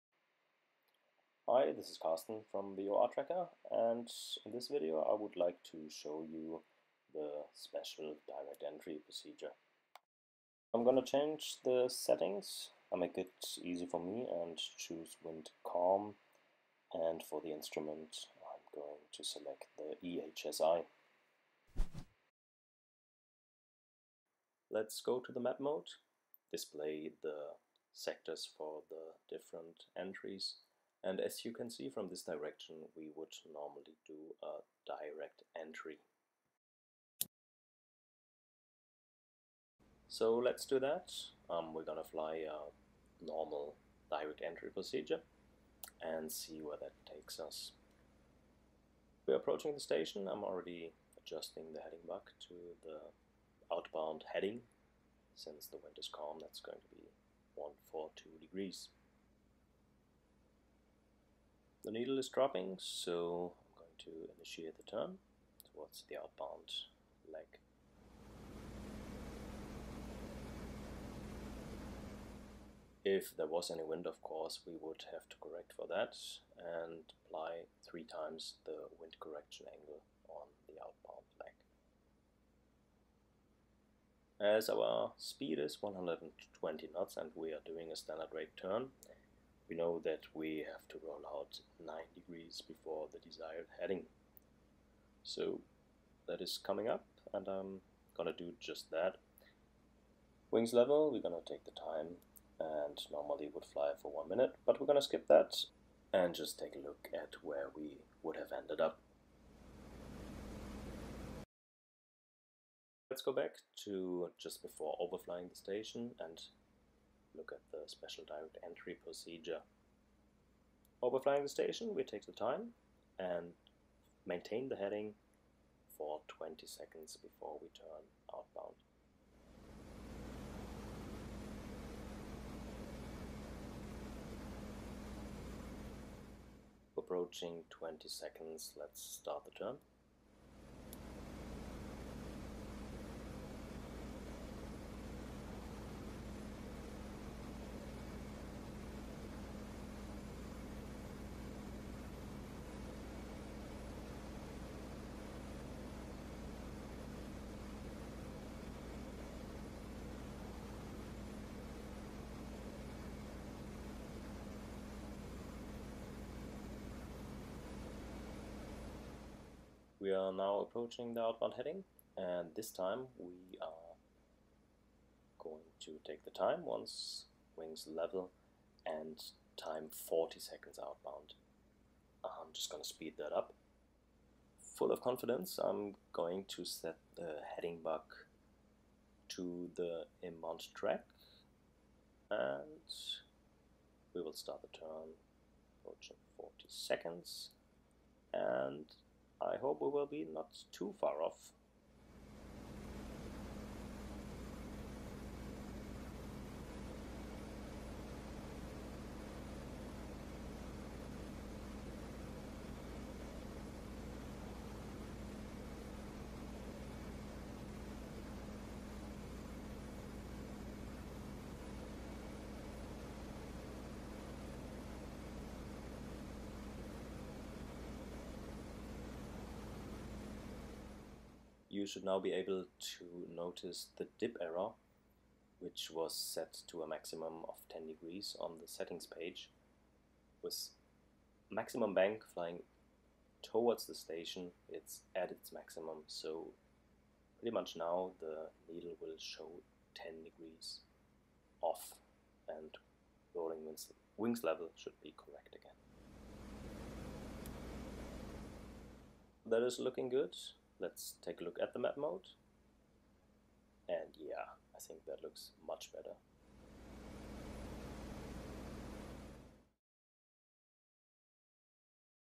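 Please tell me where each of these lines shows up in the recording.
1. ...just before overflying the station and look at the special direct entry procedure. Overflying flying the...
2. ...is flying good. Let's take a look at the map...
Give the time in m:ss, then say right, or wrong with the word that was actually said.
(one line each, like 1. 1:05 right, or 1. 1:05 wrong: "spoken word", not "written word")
1. 1:54 right
2. 4:19 wrong: "looking", not "flying".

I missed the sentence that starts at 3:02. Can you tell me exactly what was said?
I'm just going to speed that up.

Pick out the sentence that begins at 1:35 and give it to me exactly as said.
So that is coming up and I'm gonna do just that.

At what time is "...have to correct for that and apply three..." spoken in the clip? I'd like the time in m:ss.
1:15.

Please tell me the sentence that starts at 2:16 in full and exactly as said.
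Approaching 20 seconds, let's start the turn.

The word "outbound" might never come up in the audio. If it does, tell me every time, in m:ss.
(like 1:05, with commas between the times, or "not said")
0:53, 1:06, 1:20, 2:08, 2:51, 3:00.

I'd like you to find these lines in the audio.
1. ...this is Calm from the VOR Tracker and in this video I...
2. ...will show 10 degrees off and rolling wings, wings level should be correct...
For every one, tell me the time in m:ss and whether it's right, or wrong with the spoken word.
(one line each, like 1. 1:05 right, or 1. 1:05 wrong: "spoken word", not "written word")
1. 0:01 wrong: "Carsten", not "Calm"
2. 4:09 right.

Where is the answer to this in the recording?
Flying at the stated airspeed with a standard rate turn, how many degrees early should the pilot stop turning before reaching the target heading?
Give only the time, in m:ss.
1:31.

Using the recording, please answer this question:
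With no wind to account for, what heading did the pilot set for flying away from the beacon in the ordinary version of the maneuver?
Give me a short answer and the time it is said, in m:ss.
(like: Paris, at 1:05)
142 degrees, at 0:57.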